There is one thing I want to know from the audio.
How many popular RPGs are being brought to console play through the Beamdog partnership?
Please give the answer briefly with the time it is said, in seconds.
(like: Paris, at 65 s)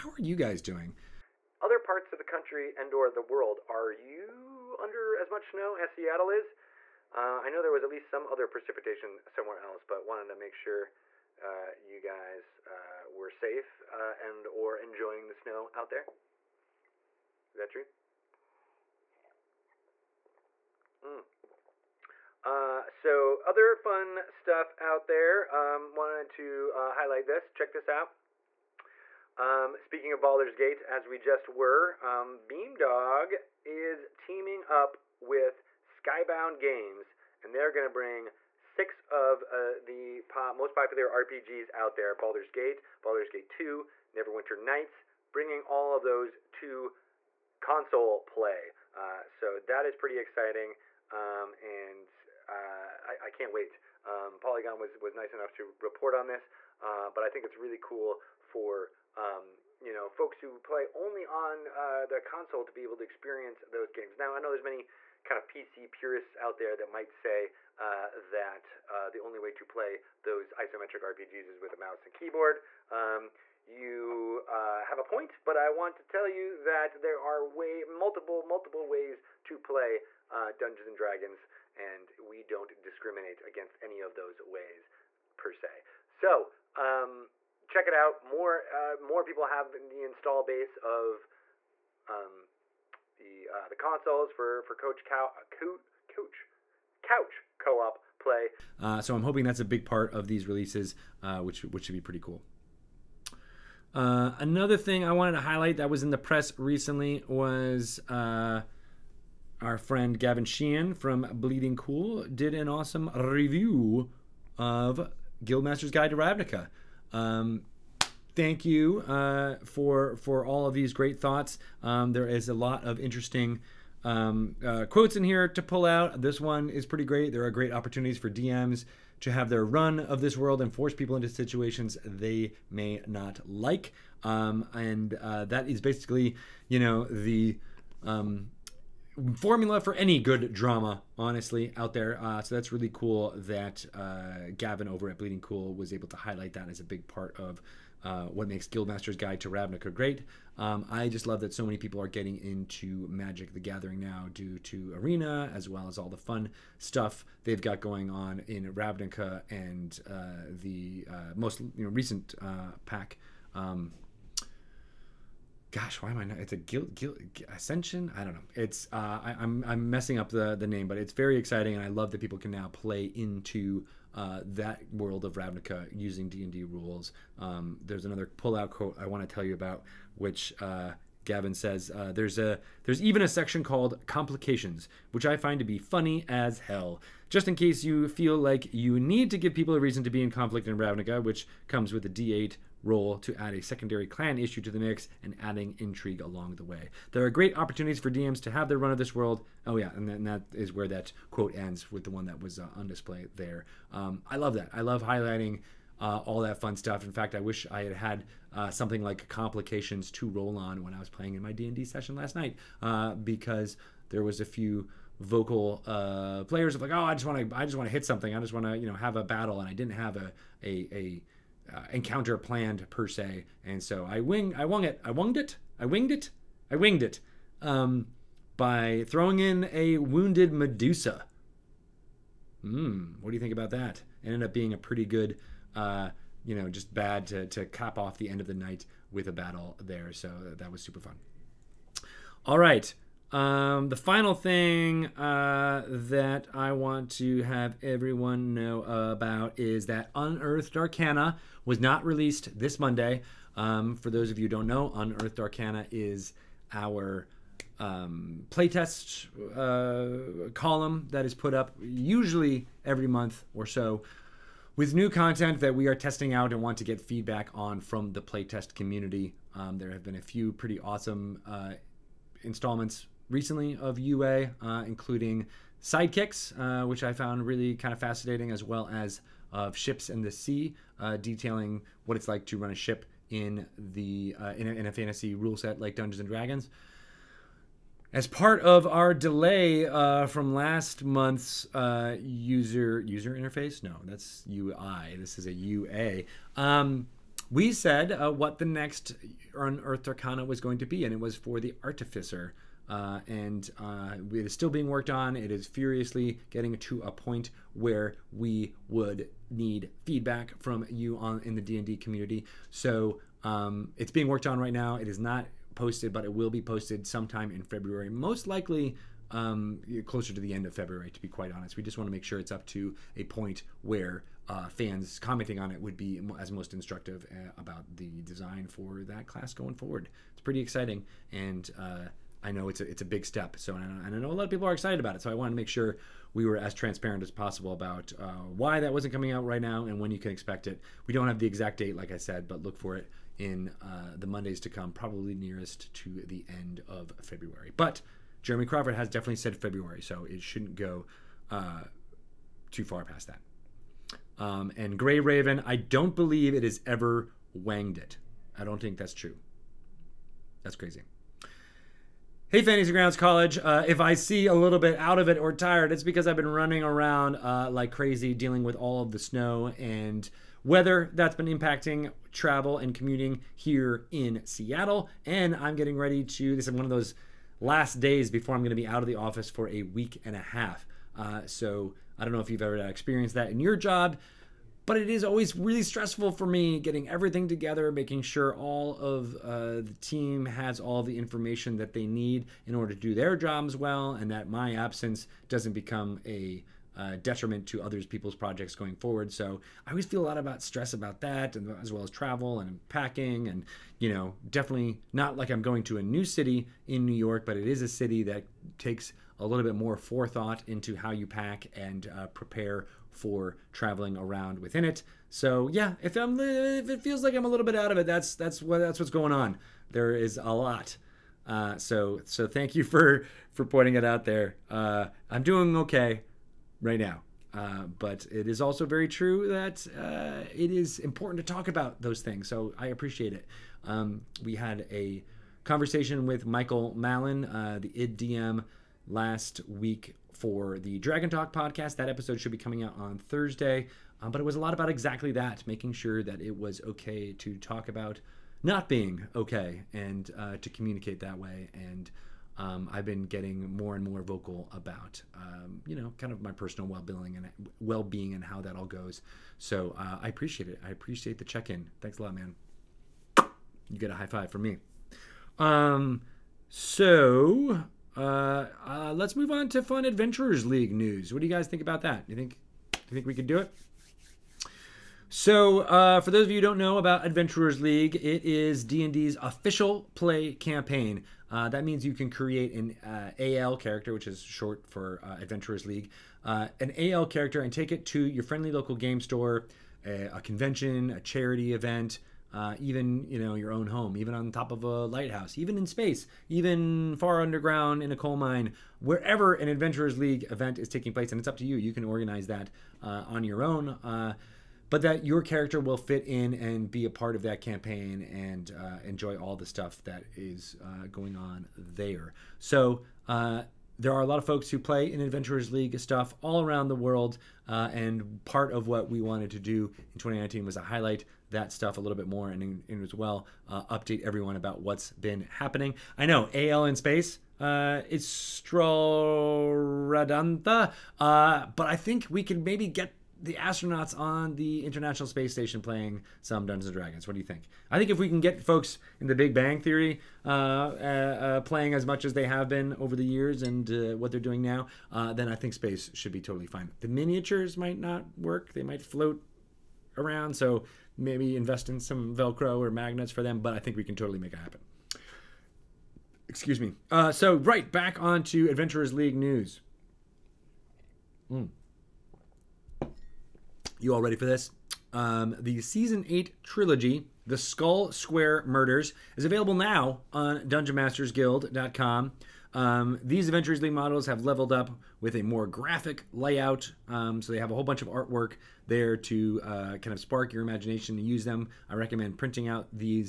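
6, at 38 s.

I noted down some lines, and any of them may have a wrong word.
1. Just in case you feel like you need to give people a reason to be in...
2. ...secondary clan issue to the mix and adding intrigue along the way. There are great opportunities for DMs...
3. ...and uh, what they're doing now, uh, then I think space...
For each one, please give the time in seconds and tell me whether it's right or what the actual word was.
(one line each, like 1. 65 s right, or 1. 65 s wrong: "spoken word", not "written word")
1. 187 s right
2. 193 s right
3. 543 s right.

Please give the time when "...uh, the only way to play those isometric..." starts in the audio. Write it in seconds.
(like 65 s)
68 s.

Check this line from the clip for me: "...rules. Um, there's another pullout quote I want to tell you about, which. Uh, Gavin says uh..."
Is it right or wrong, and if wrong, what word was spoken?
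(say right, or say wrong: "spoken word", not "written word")
right.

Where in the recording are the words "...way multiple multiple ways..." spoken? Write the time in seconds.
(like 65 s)
77 s.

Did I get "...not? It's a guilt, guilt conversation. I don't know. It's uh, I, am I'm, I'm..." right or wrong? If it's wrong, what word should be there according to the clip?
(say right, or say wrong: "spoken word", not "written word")
wrong: "ascension", not "conversation".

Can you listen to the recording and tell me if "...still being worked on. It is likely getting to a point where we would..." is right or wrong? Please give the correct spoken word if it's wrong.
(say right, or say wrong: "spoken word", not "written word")
wrong: "furiously", not "likely".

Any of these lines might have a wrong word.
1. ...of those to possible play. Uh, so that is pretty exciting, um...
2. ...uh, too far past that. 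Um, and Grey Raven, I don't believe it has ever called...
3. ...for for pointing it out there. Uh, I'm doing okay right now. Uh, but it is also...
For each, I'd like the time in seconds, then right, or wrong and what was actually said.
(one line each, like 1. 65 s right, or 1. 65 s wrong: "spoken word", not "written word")
1. 45 s wrong: "console", not "possible"
2. 351 s wrong: "wanged", not "called"
3. 422 s right.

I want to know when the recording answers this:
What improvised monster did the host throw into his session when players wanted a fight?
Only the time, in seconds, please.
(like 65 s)
229 s.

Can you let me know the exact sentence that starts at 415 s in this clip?
So yeah, if I'm if it feels like I'm a little bit out of it, that's that's what that's what's going on.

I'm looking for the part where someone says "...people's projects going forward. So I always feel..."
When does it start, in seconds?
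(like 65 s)
398 s.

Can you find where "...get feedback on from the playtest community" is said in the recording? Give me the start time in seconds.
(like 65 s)
266 s.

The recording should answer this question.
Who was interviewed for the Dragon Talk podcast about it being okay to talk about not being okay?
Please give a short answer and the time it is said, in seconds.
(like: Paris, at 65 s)
Michael Mallon, at 436 s.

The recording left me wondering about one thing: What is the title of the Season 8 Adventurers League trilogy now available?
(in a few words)
The Skull Square Murders.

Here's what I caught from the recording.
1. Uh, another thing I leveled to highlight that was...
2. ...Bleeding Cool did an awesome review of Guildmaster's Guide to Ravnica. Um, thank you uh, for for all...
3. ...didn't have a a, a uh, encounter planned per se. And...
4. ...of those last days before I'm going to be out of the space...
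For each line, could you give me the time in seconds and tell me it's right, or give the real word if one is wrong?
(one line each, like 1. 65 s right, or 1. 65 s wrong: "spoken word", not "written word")
1. 103 s wrong: "wanted", not "leveled"
2. 111 s right
3. 219 s right
4. 376 s wrong: "office", not "space".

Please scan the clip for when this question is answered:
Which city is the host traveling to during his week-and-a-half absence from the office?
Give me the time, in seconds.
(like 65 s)
407 s.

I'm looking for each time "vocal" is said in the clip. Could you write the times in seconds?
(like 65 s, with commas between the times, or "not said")
215 s, 454 s.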